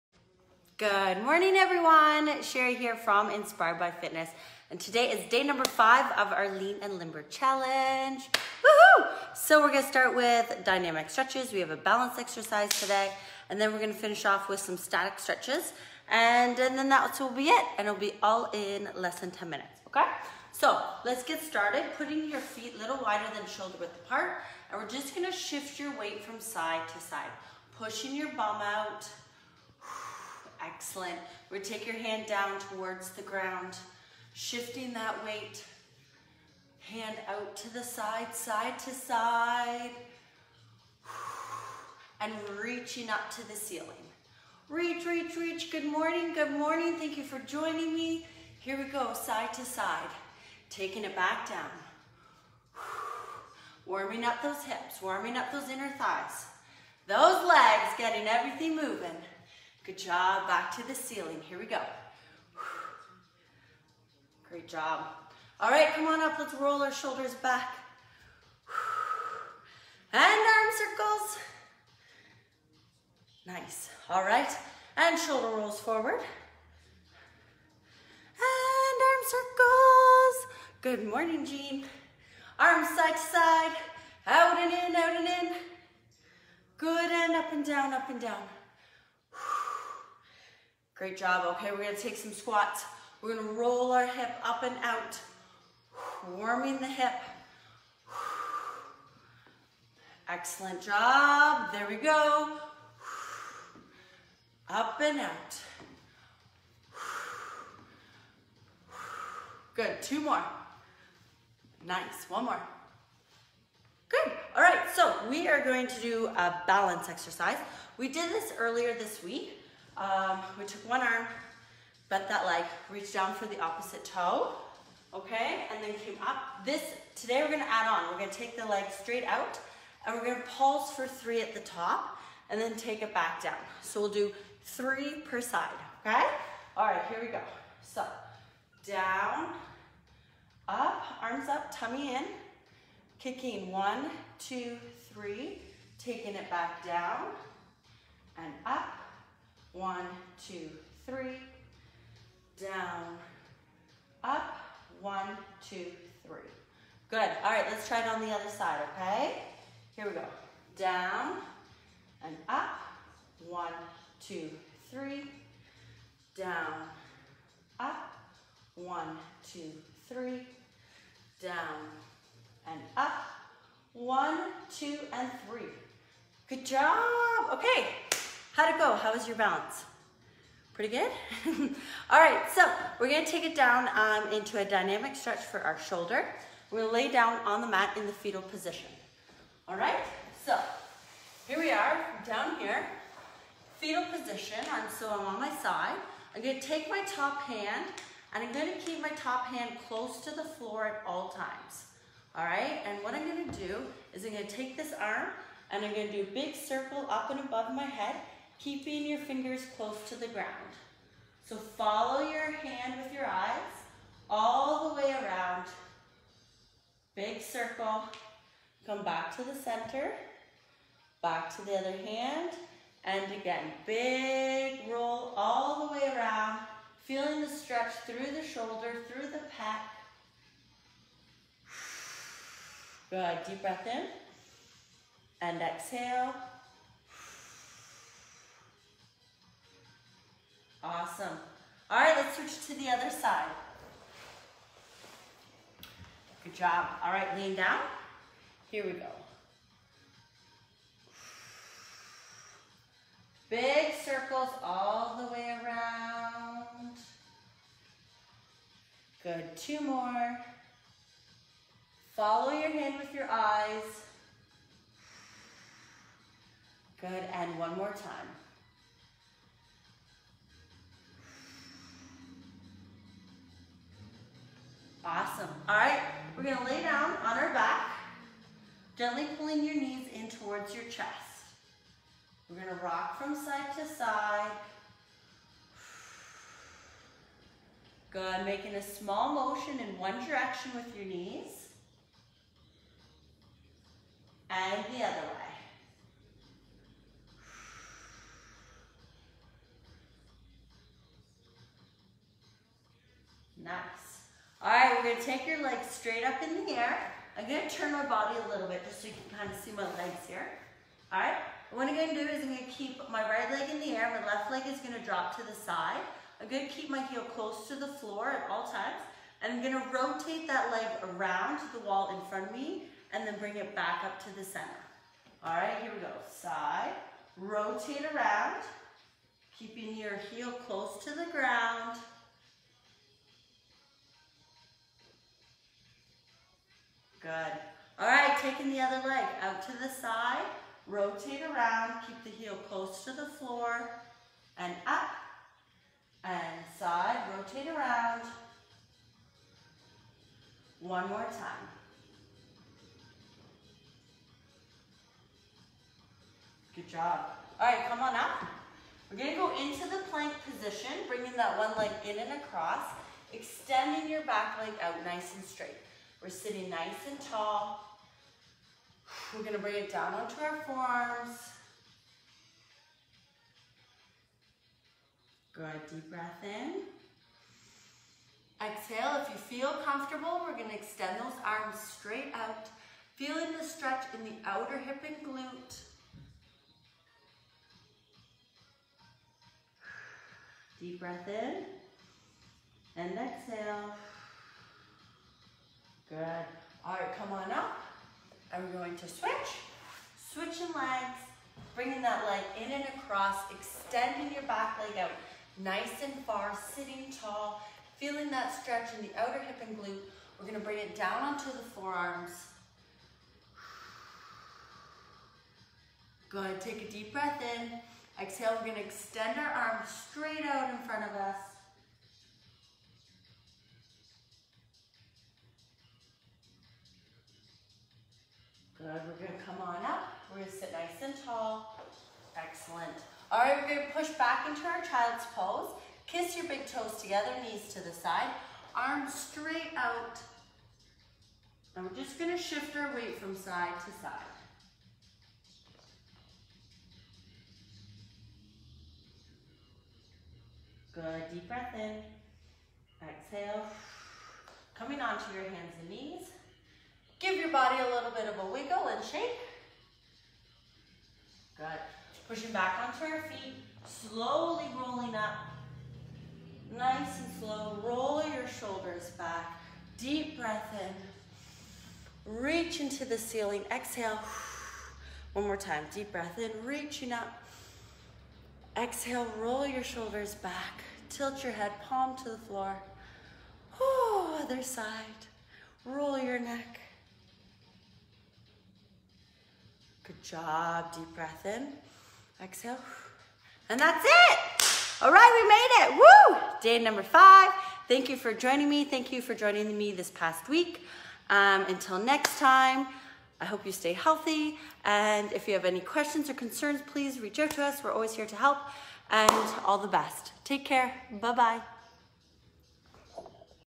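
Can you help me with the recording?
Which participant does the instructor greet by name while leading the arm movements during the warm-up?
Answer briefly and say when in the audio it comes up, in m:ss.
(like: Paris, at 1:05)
Jean, at 1:21.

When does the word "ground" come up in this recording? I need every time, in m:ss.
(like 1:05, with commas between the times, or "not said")
0:33, 3:30, 5:31.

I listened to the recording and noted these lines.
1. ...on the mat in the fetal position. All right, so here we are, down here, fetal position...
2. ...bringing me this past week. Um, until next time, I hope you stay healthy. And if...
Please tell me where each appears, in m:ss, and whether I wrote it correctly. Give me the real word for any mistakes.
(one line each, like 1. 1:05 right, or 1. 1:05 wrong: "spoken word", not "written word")
1. 3:07 right
2. 8:19 wrong: "joining", not "bringing".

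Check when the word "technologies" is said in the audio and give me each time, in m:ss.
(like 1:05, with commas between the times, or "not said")
not said.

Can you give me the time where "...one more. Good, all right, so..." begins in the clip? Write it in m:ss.
1:52.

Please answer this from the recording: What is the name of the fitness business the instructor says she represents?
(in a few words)
Inspired by Fitness.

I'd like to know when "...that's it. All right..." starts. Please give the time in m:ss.
8:13.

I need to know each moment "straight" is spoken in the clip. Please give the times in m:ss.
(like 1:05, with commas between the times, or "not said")
2:09, 5:05, 6:05, 6:21, 7:00, 7:19.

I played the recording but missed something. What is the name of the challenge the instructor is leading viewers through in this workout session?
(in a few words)
Lean and Limber Challenge.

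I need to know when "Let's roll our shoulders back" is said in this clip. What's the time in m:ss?
1:06.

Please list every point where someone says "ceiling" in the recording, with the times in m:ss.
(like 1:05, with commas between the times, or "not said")
0:43, 1:00, 7:53.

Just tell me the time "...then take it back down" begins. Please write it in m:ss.
2:12.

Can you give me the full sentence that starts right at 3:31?
So follow your hand with your eyes all the way around.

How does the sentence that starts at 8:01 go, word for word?
Tilt your head, palm to the floor.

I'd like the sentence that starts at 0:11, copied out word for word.
We have a balance exercise today.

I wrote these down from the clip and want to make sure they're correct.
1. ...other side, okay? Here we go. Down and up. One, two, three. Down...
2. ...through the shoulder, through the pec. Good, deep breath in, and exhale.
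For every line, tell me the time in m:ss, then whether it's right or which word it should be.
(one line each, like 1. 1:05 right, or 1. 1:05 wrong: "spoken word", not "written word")
1. 2:38 right
2. 3:48 right.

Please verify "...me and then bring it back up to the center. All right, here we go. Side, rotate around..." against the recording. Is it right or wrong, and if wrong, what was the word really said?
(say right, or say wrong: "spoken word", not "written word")
right.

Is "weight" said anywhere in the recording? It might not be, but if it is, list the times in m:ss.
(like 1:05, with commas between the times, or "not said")
0:25, 0:35, 7:22.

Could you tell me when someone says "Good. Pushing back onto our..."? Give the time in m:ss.
7:41.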